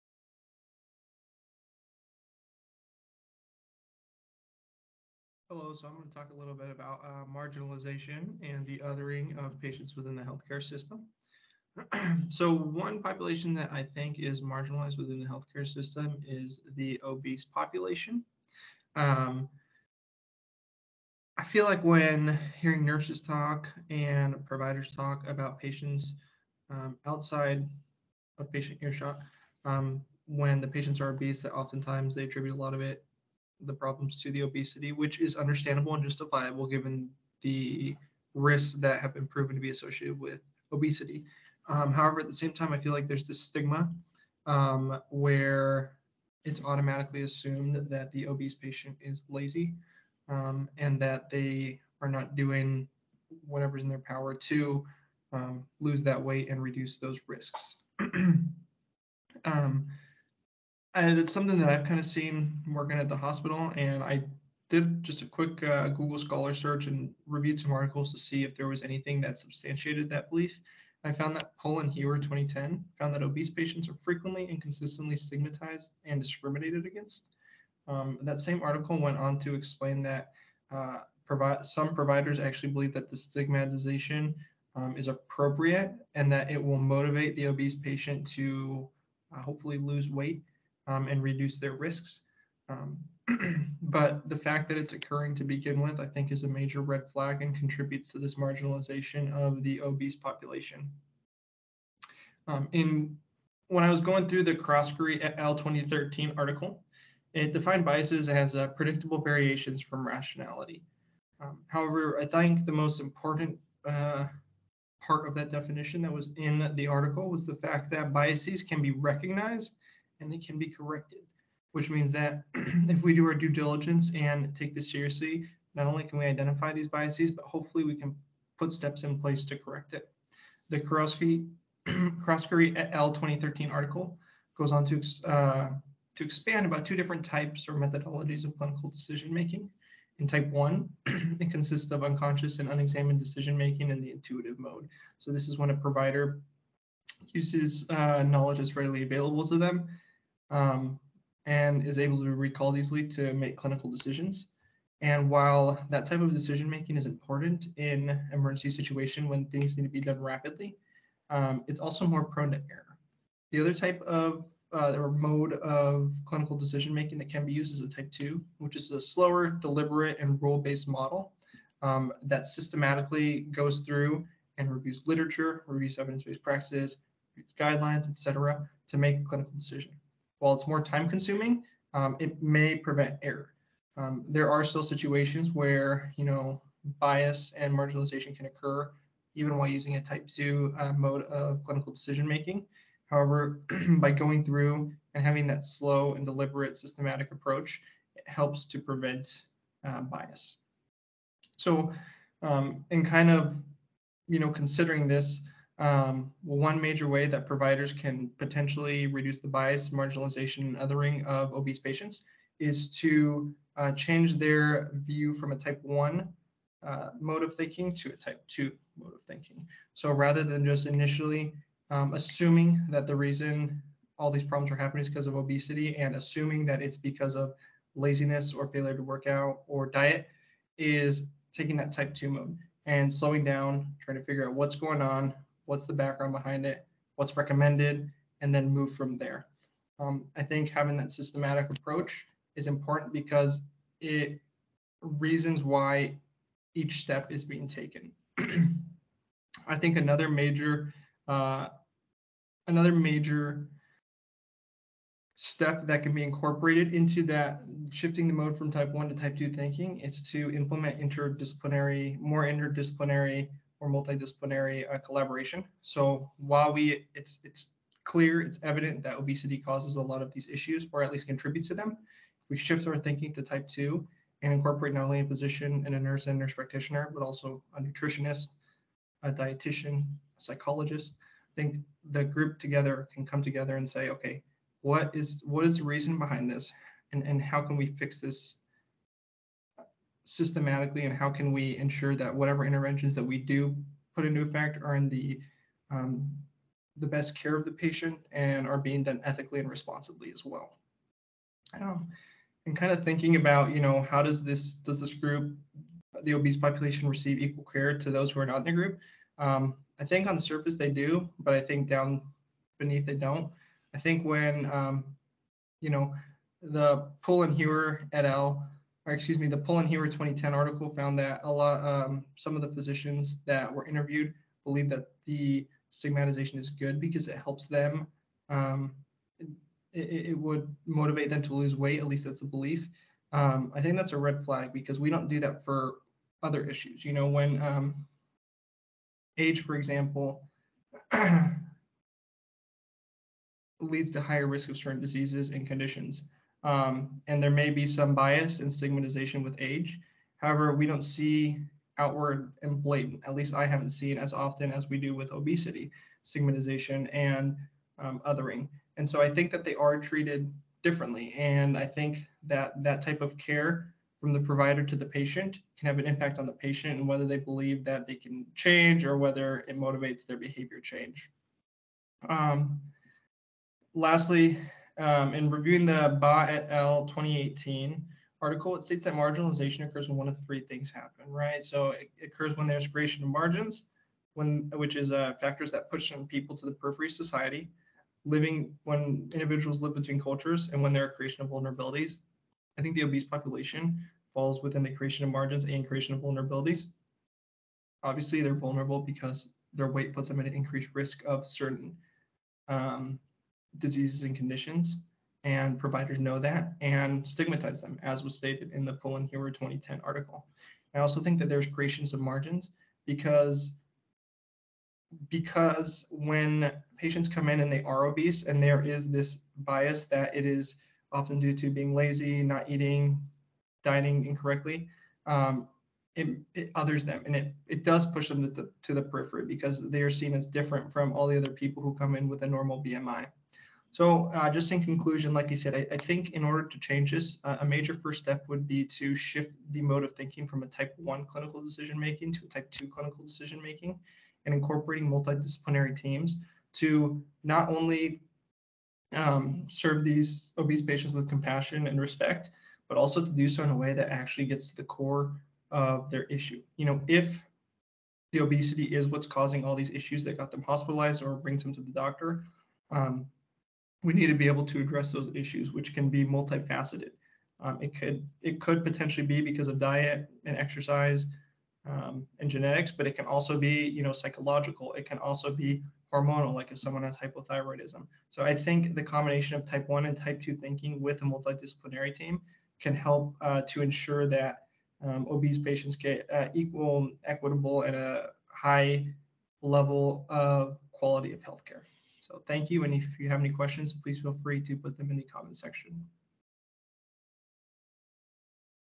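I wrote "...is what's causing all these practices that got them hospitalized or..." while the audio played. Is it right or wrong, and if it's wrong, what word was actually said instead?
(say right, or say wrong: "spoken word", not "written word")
wrong: "issues", not "practices".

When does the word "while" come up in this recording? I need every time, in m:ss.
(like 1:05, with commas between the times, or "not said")
2:35, 3:00, 3:09, 4:26.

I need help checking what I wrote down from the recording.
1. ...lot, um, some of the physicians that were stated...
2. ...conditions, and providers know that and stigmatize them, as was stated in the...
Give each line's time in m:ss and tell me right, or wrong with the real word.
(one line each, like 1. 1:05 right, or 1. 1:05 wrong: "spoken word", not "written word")
1. 5:21 wrong: "interviewed", not "stated"
2. 6:44 right.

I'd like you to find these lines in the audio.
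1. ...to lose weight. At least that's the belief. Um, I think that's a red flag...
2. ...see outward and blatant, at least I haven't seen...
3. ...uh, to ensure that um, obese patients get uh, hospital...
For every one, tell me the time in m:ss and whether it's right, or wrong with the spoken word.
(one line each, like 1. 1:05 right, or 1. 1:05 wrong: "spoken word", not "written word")
1. 5:31 right
2. 5:51 right
3. 8:03 wrong: "equal", not "hospital".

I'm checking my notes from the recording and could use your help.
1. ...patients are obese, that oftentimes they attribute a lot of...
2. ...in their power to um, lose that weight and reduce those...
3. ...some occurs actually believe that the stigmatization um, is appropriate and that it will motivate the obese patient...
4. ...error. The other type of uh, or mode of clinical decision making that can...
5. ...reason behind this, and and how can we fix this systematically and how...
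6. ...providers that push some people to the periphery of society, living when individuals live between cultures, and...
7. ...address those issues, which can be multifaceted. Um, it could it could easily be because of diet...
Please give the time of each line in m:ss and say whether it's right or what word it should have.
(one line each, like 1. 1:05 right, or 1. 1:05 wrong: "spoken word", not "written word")
1. 0:30 right
2. 0:53 right
3. 1:21 wrong: "providers", not "occurs"
4. 2:42 right
5. 4:45 right
6. 6:25 wrong: "factors", not "providers"
7. 7:44 wrong: "potentially", not "easily".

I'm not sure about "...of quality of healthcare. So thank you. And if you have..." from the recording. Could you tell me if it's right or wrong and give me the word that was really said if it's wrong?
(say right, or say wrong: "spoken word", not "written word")
right.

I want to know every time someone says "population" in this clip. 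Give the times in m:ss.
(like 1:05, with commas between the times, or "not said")
0:13, 0:17, 1:40, 5:06, 6:33.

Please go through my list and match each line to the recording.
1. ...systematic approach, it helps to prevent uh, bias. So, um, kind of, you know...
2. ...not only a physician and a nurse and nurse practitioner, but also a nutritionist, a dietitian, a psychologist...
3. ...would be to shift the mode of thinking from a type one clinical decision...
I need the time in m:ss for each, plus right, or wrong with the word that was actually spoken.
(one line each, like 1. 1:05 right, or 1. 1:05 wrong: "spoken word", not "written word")
1. 3:16 right
2. 4:34 right
3. 7:18 right.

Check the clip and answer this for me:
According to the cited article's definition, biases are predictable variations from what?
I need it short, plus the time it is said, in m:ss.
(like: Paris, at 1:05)
rationality, at 1:50.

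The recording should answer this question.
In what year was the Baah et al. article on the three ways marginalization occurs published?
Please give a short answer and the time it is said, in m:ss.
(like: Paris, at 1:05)
2018, at 6:16.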